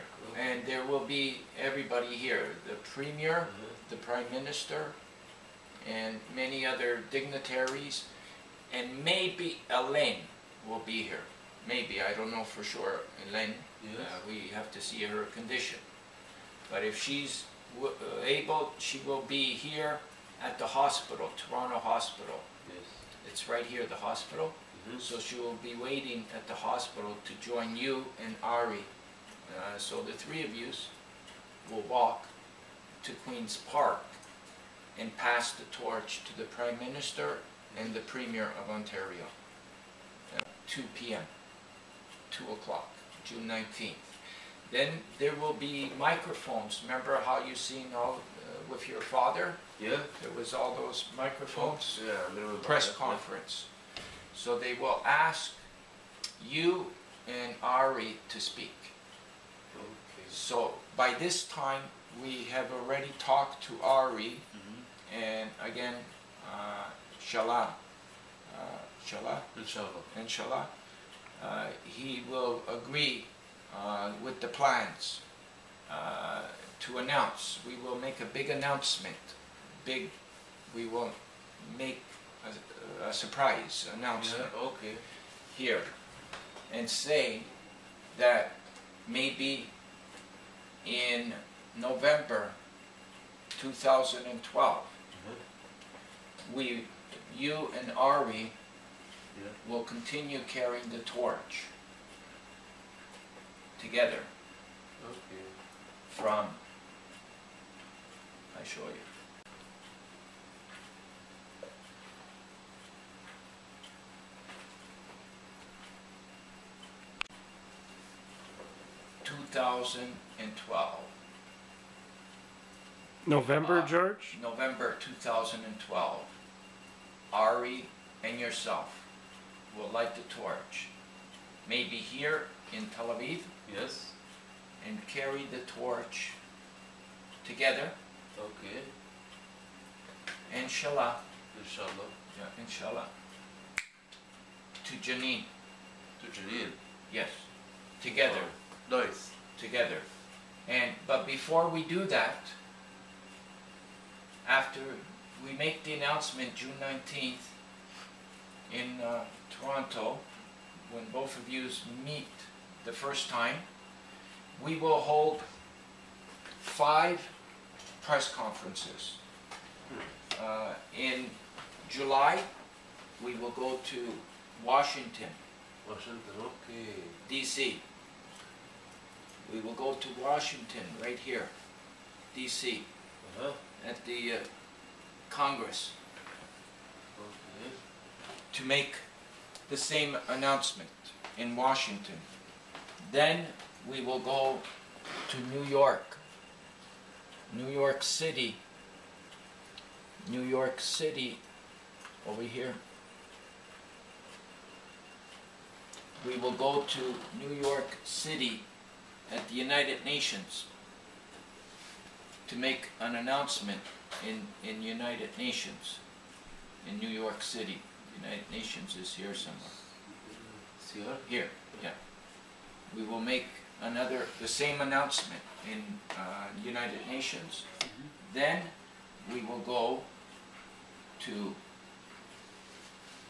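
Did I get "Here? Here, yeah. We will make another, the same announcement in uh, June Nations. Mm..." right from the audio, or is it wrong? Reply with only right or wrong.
wrong.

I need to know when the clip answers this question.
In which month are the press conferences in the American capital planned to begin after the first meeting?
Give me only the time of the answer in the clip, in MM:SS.
02:51.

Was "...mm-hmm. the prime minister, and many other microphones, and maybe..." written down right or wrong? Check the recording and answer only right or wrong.
wrong.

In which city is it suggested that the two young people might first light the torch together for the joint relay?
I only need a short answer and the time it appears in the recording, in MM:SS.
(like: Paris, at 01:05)
Tel Aviv, at 02:12.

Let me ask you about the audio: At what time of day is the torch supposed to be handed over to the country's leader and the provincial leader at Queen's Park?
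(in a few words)
2 PM.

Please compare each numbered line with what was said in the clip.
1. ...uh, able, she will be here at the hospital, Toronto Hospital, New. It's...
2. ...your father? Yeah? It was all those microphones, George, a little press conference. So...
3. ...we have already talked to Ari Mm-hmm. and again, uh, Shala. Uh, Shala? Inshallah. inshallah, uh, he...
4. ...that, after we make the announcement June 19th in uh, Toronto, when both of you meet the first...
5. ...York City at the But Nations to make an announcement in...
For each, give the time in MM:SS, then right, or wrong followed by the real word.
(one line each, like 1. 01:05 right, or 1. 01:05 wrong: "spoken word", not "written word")
1. 00:18 wrong: "Yes", not "New"
2. 00:48 wrong: "Yeah", not "George"
3. 01:02 right
4. 02:32 right
5. 03:27 wrong: "United", not "But".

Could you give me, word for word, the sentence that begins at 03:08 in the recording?
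to make the same announcement in Washington.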